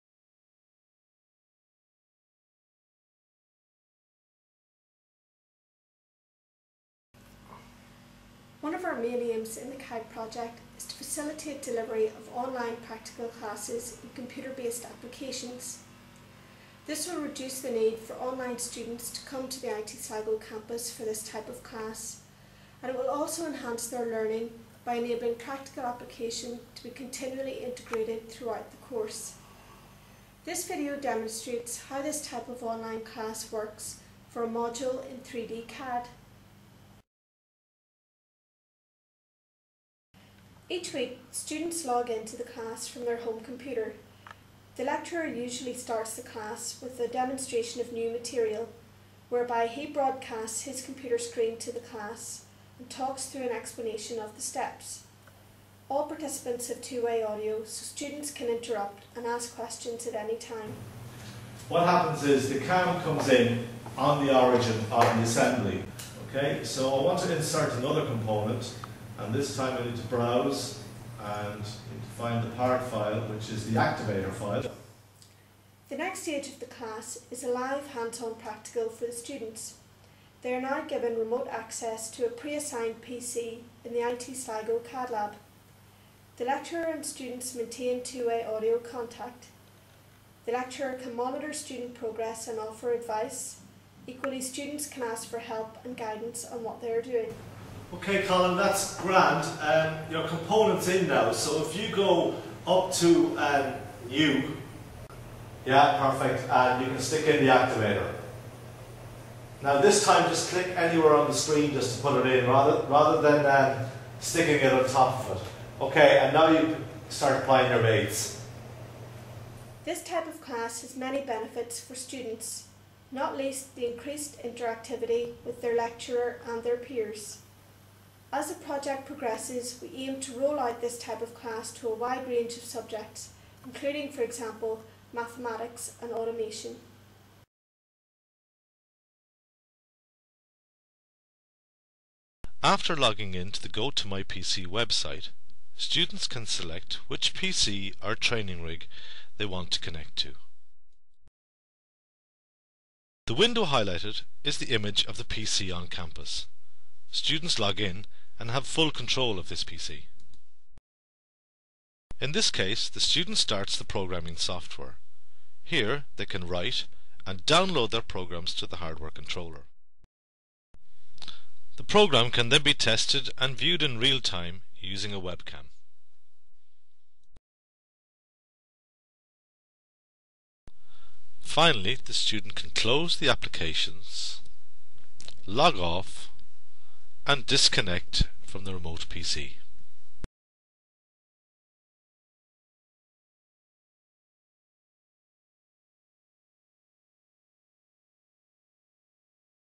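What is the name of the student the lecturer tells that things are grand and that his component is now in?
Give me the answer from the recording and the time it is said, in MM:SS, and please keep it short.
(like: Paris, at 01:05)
Colin, at 01:38.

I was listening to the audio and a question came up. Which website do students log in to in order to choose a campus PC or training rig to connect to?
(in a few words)
Go to My PC.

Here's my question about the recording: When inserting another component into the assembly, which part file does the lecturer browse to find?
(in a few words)
activator file.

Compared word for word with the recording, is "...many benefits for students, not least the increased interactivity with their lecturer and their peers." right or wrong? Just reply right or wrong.
right.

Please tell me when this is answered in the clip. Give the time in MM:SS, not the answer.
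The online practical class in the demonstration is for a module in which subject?
00:35.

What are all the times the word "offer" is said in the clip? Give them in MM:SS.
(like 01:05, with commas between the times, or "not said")
01:32.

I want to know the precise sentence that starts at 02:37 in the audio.
Students log in and have full control of this PC.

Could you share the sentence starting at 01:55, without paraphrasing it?
Okay, and now you start applying your mates.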